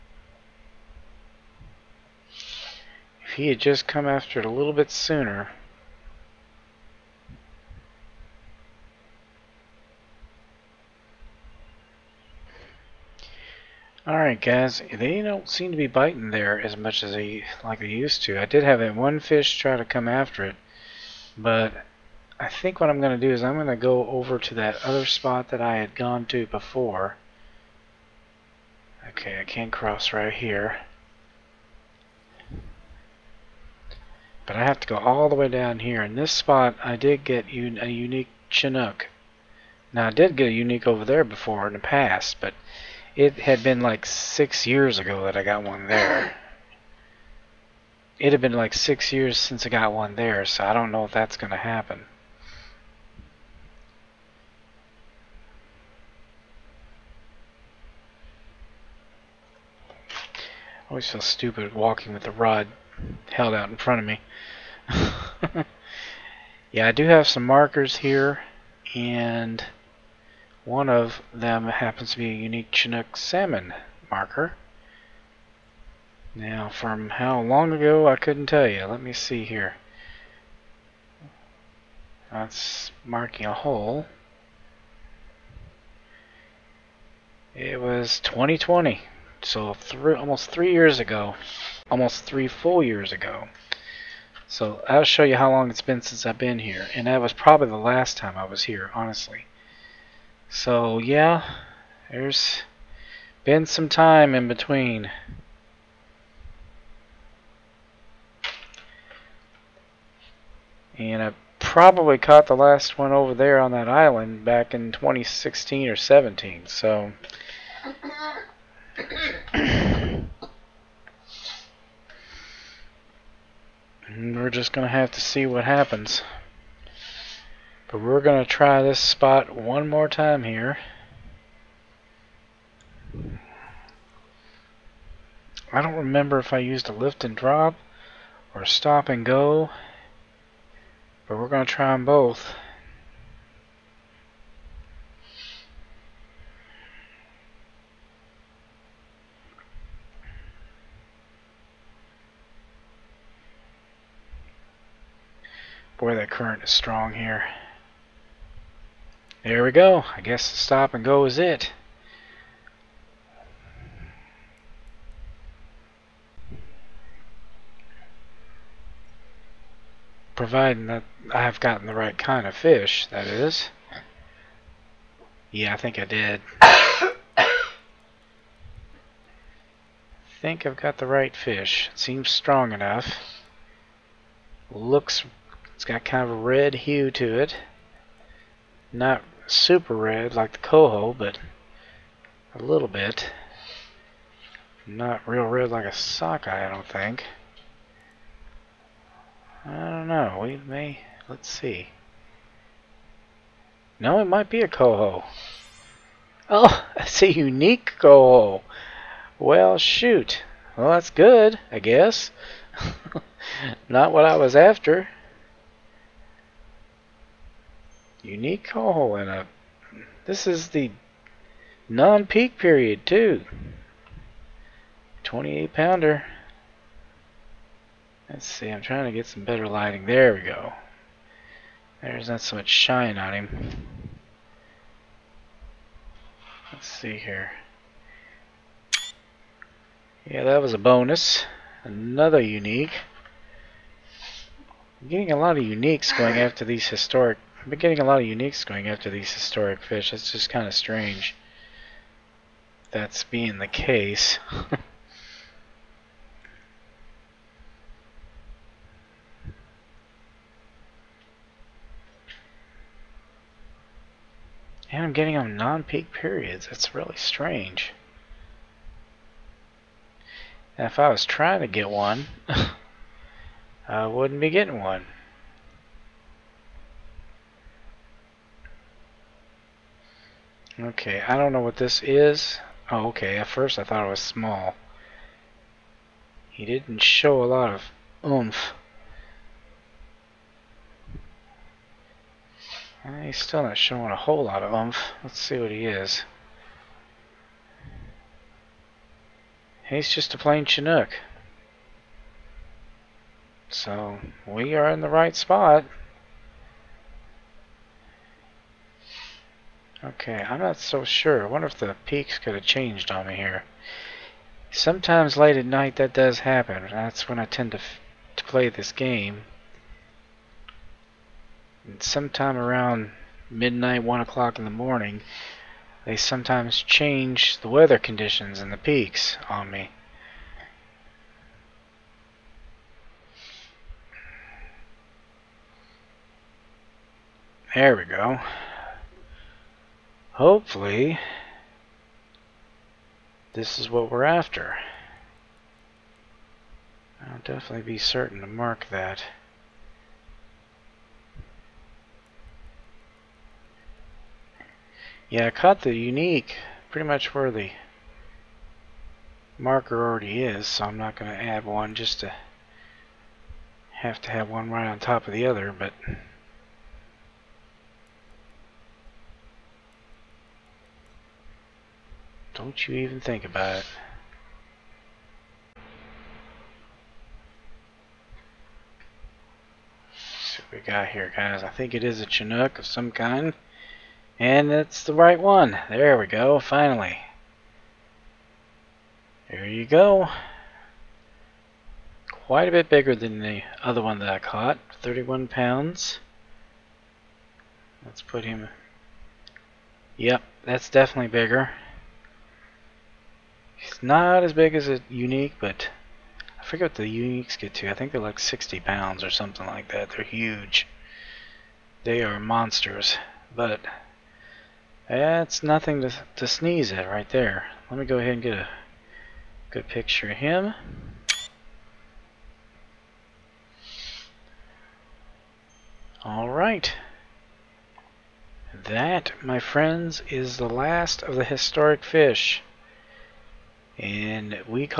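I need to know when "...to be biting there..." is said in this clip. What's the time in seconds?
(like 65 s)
15 s.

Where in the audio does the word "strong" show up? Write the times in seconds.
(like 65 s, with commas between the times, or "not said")
156 s, 182 s.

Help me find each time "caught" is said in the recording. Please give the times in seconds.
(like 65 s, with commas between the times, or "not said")
112 s, 355 s, 394 s.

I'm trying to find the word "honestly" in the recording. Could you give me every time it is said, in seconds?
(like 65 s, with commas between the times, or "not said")
98 s.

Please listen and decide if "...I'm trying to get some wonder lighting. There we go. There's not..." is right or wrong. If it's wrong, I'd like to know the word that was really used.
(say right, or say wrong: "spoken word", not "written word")
wrong: "better", not "wonder".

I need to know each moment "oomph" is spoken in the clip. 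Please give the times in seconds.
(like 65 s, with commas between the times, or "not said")
288 s, 294 s.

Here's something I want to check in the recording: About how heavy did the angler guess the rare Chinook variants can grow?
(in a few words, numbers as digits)
60 pounds.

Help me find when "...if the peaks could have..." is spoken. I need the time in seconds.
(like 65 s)
311 s.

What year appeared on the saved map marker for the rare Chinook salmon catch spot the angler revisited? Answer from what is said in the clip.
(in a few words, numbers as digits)
2020.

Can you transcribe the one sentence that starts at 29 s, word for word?
Okay, I can't cross right here.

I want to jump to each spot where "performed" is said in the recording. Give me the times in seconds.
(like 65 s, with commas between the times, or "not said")
not said.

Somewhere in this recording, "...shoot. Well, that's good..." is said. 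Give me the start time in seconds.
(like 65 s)
209 s.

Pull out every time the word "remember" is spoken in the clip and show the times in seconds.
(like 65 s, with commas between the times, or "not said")
135 s.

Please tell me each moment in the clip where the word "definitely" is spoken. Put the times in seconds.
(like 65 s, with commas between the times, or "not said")
347 s, 400 s.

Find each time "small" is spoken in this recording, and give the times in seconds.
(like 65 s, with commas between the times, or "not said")
284 s.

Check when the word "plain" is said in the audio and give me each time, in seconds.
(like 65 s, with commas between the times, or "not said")
300 s.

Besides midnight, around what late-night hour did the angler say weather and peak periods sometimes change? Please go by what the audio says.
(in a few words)
1 o'clock.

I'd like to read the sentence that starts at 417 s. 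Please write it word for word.
Let me go ahead and get a good picture of him.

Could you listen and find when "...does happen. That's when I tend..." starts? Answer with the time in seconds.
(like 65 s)
316 s.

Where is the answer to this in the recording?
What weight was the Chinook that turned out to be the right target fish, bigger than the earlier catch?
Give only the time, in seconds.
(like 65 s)
395 s.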